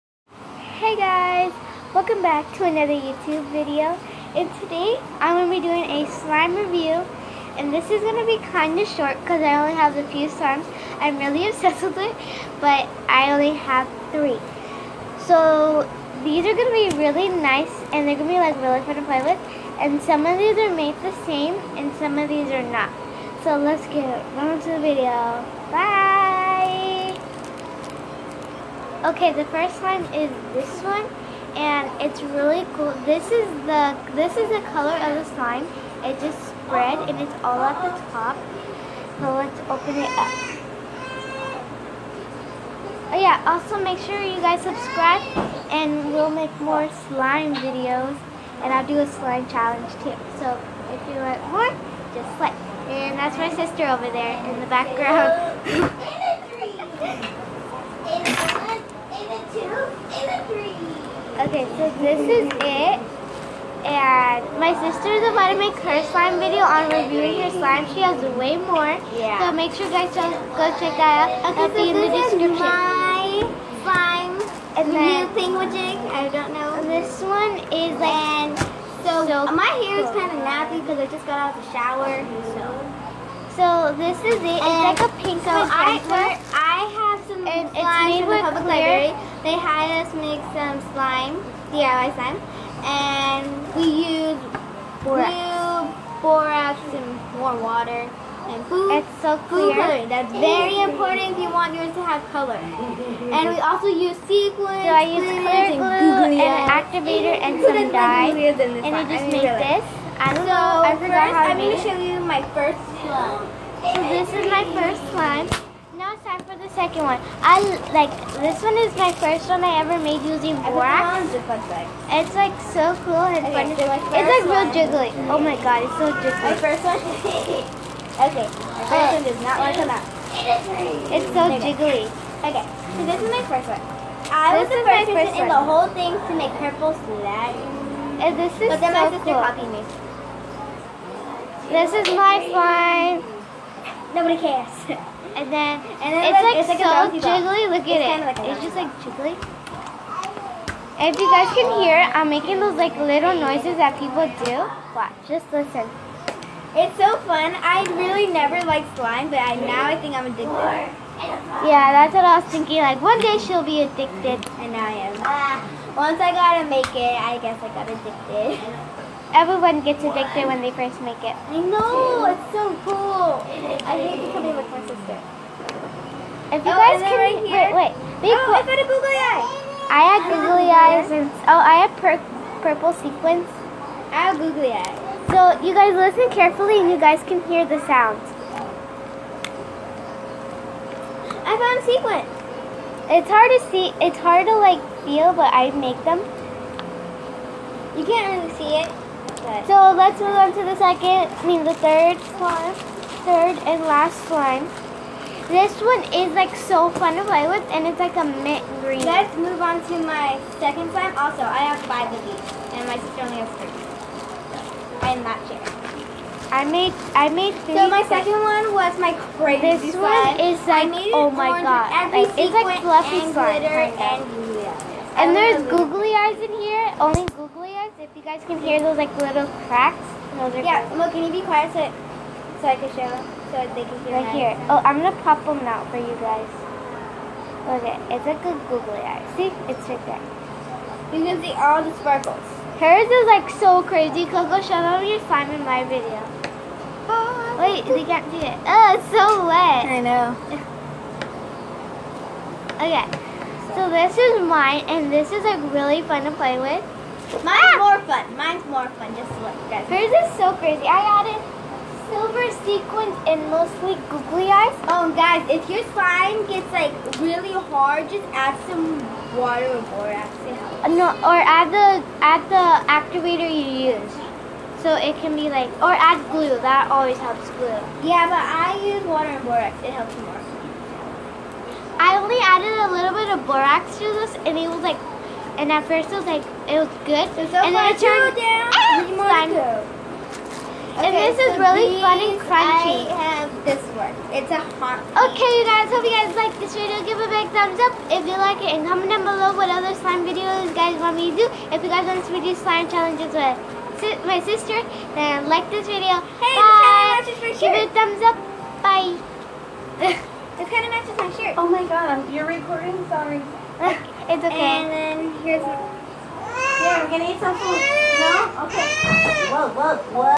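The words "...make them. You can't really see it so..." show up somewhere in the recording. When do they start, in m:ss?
3:15.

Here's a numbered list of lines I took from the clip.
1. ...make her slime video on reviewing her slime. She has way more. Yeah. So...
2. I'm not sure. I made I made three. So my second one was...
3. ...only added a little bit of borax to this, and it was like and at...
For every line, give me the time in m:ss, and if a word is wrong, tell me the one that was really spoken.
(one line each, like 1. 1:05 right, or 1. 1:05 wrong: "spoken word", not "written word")
1. 1:05 right
2. 3:35 right
3. 4:42 right.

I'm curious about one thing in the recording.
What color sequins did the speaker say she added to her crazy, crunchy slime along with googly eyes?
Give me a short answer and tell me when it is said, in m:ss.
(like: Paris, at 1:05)
Silver, at 4:22.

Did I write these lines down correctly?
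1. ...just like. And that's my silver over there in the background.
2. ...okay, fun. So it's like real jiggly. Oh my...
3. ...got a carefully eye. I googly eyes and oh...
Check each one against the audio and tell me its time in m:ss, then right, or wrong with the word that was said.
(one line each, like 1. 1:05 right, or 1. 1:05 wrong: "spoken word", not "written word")
1. 0:52 wrong: "sister", not "silver"
2. 2:03 right
3. 2:58 wrong: "googly", not "carefully".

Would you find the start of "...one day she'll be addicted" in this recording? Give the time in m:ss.
2:43.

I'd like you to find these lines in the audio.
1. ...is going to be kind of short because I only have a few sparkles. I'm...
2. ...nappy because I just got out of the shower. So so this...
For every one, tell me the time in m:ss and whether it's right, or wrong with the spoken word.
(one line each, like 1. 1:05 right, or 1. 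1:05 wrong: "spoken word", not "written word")
1. 0:07 wrong: "slimes", not "sparkles"
2. 1:20 right.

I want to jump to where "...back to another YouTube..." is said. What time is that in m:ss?
0:02.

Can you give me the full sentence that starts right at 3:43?
Glitter and, and, and there's googly eyes in here.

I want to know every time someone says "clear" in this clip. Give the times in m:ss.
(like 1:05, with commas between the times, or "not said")
1:39, 1:45.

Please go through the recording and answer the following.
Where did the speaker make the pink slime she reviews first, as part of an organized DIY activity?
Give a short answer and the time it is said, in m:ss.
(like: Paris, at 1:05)
Public library, at 1:28.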